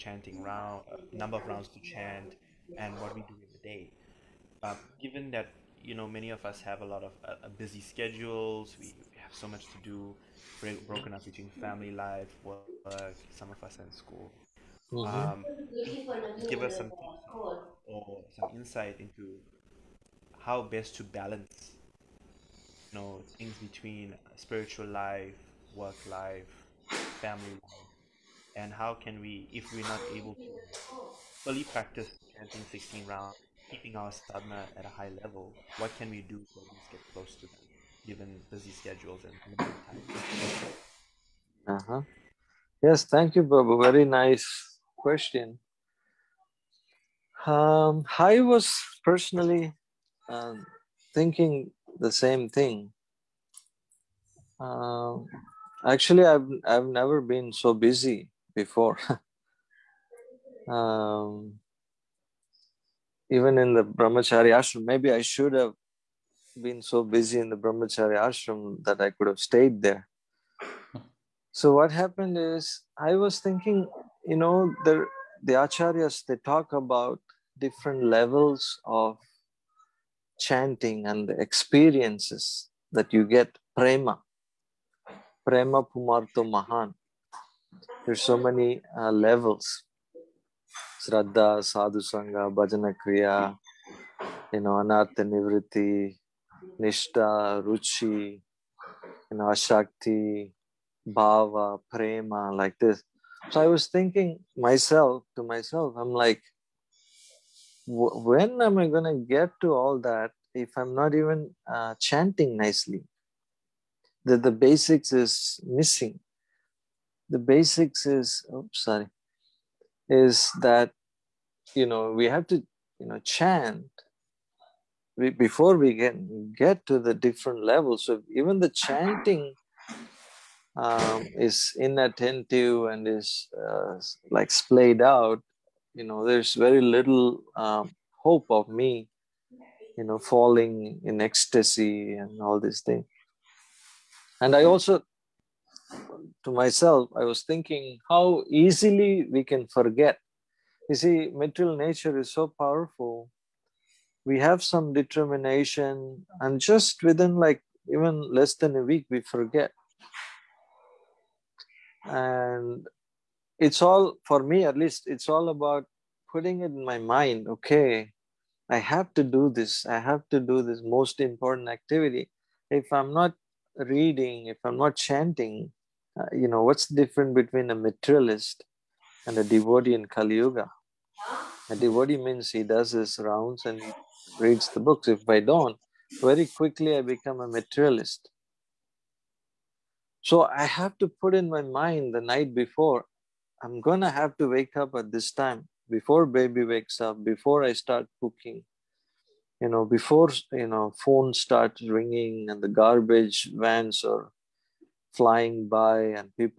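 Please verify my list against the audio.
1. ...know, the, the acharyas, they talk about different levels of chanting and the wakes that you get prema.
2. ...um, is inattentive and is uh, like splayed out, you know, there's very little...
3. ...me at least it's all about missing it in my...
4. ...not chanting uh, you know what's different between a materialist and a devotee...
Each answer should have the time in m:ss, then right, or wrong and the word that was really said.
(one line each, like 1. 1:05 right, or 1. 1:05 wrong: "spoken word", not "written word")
1. 1:14 wrong: "experiences", not "wakes"
2. 2:10 right
3. 2:44 wrong: "putting", not "missing"
4. 2:54 right.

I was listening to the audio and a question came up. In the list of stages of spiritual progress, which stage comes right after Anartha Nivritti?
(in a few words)
Nishta.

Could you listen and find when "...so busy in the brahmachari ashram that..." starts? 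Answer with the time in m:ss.
1:06.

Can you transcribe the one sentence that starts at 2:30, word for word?
You see, material nature is so powerful.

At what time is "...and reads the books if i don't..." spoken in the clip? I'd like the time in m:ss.
3:03.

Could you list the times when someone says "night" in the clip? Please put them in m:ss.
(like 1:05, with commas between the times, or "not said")
3:12.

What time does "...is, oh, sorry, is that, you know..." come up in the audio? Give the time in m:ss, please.
1:58.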